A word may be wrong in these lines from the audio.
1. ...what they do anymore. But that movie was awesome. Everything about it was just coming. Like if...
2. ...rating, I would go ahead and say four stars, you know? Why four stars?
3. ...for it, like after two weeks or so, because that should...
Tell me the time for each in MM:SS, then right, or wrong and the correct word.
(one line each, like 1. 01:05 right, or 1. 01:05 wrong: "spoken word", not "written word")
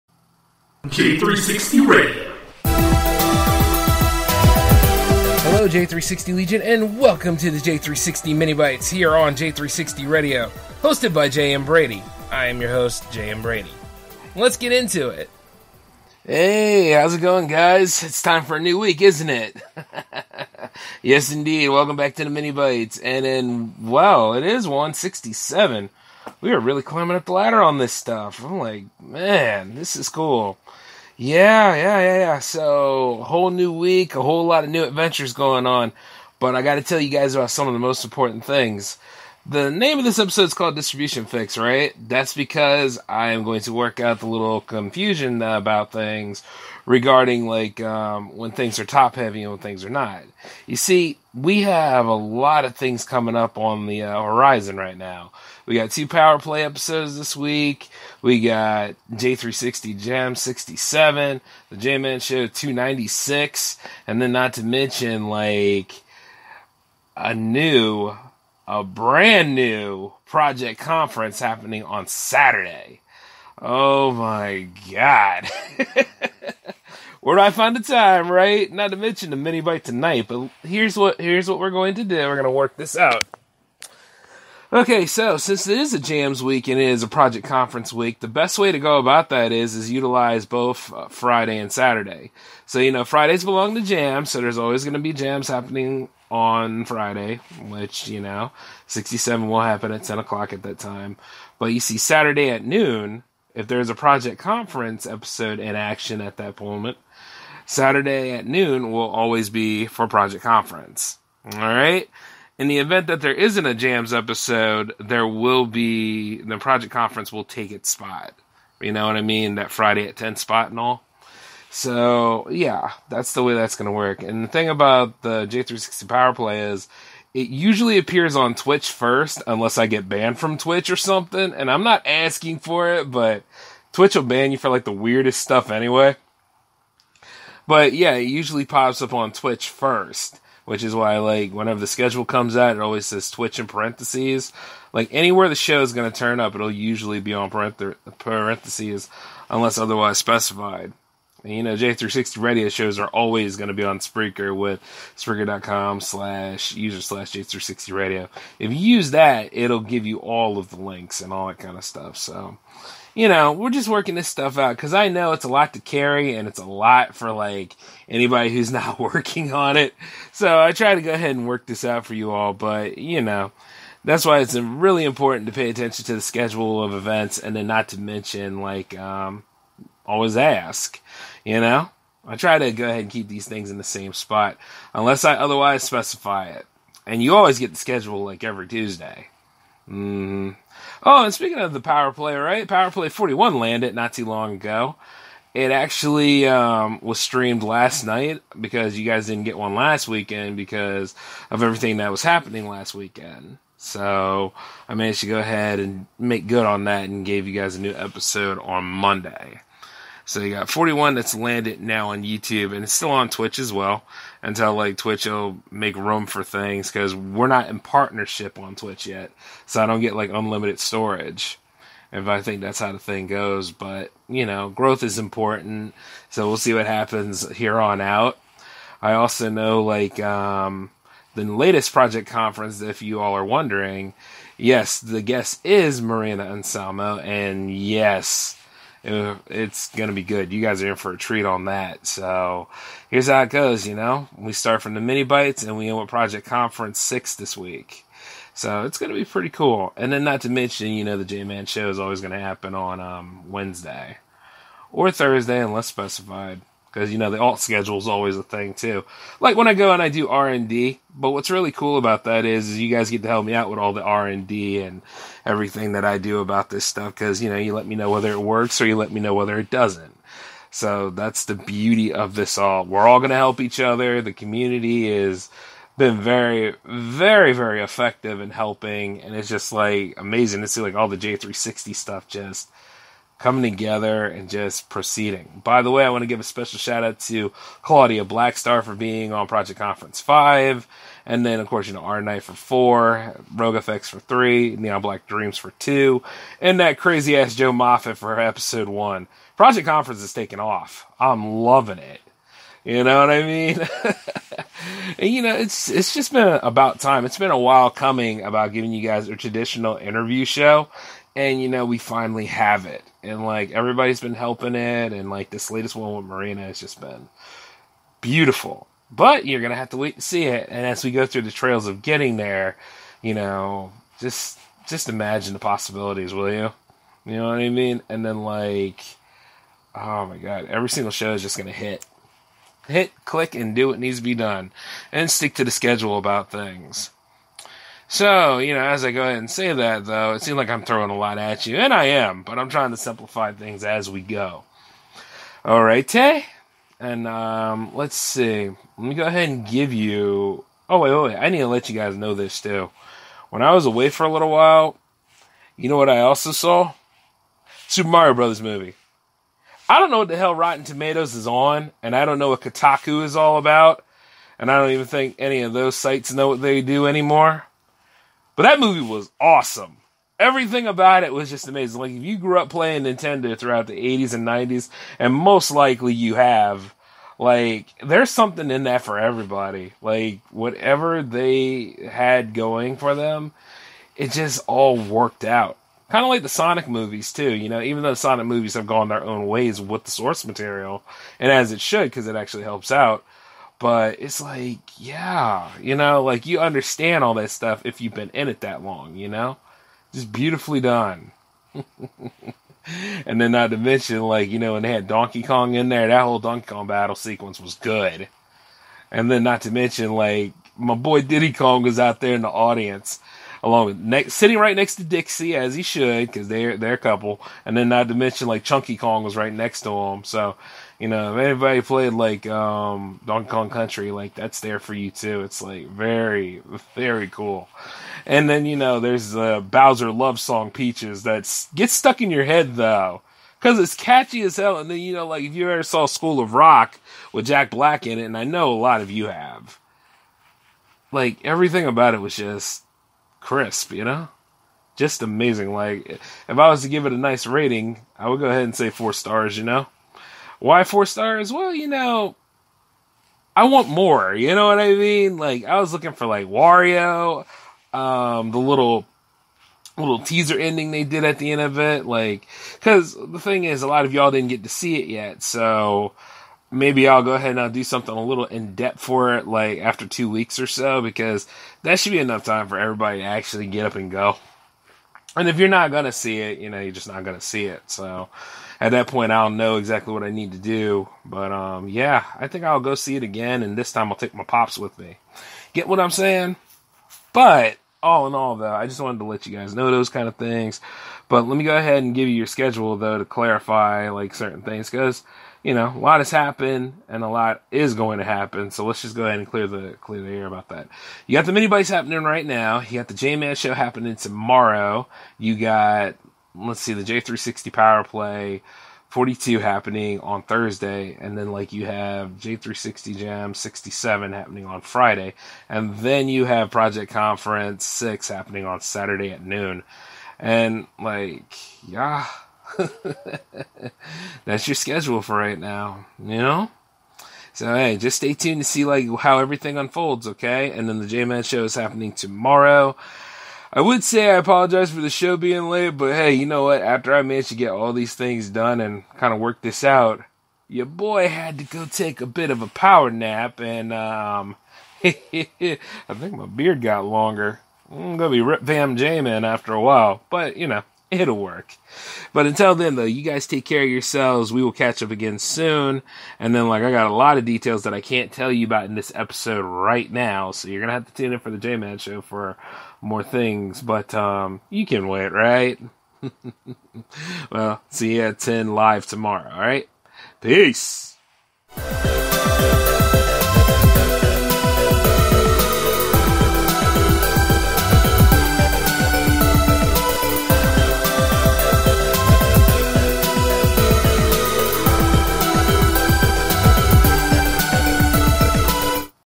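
1. 06:06 wrong: "amazing", not "coming"
2. 07:27 right
3. 07:48 right.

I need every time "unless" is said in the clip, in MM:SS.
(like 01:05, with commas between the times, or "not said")
02:09, 02:29, 03:04, 04:15.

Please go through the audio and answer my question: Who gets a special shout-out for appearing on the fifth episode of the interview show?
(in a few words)
Claudia Blackstar.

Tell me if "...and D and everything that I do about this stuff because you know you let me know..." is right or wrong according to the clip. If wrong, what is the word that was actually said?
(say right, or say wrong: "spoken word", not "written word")
right.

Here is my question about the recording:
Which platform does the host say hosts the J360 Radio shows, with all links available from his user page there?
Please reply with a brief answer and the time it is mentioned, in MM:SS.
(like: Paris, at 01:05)
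Spreaker, at 02:33.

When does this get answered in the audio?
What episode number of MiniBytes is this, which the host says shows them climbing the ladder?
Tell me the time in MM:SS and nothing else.
00:24.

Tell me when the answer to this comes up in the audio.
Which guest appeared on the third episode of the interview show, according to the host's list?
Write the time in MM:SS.
04:53.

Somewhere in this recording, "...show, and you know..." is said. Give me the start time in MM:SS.
05:10.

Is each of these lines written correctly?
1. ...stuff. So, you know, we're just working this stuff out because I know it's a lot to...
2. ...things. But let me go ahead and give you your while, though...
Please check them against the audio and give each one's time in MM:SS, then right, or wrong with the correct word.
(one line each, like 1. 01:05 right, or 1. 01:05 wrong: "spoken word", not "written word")
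1. 02:41 right
2. 08:10 wrong: "schedule", not "while".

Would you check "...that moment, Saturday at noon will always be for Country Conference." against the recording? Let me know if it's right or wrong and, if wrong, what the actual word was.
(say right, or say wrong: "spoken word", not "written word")
wrong: "Project", not "Country".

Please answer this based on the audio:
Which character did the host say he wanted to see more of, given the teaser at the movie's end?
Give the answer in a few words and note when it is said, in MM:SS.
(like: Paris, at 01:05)
Wario, at 07:36.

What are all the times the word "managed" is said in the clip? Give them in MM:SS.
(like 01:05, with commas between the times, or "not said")
03:24, 08:57.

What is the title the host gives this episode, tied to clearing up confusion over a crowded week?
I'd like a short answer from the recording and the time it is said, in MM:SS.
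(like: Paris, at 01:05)
Distribution Fix, at 00:40.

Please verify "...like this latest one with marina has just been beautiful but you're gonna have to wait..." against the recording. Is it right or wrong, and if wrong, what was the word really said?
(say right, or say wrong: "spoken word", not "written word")
right.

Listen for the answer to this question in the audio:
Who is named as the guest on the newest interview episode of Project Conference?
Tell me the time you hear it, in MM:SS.
03:56.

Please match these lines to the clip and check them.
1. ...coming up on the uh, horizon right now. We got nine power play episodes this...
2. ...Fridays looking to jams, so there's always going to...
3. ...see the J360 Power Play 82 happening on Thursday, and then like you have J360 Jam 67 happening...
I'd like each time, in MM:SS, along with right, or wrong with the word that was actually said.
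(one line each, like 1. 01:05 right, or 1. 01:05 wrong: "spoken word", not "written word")
1. 00:53 wrong: "two", not "nine"
2. 01:33 wrong: "belong", not "looking"
3. 08:26 wrong: "42", not "82".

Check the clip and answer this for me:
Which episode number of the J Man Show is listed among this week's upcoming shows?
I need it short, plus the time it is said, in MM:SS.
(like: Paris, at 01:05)
296, at 01:02.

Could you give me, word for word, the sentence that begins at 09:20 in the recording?
So you're going to have to tune in for the J Man show for more things.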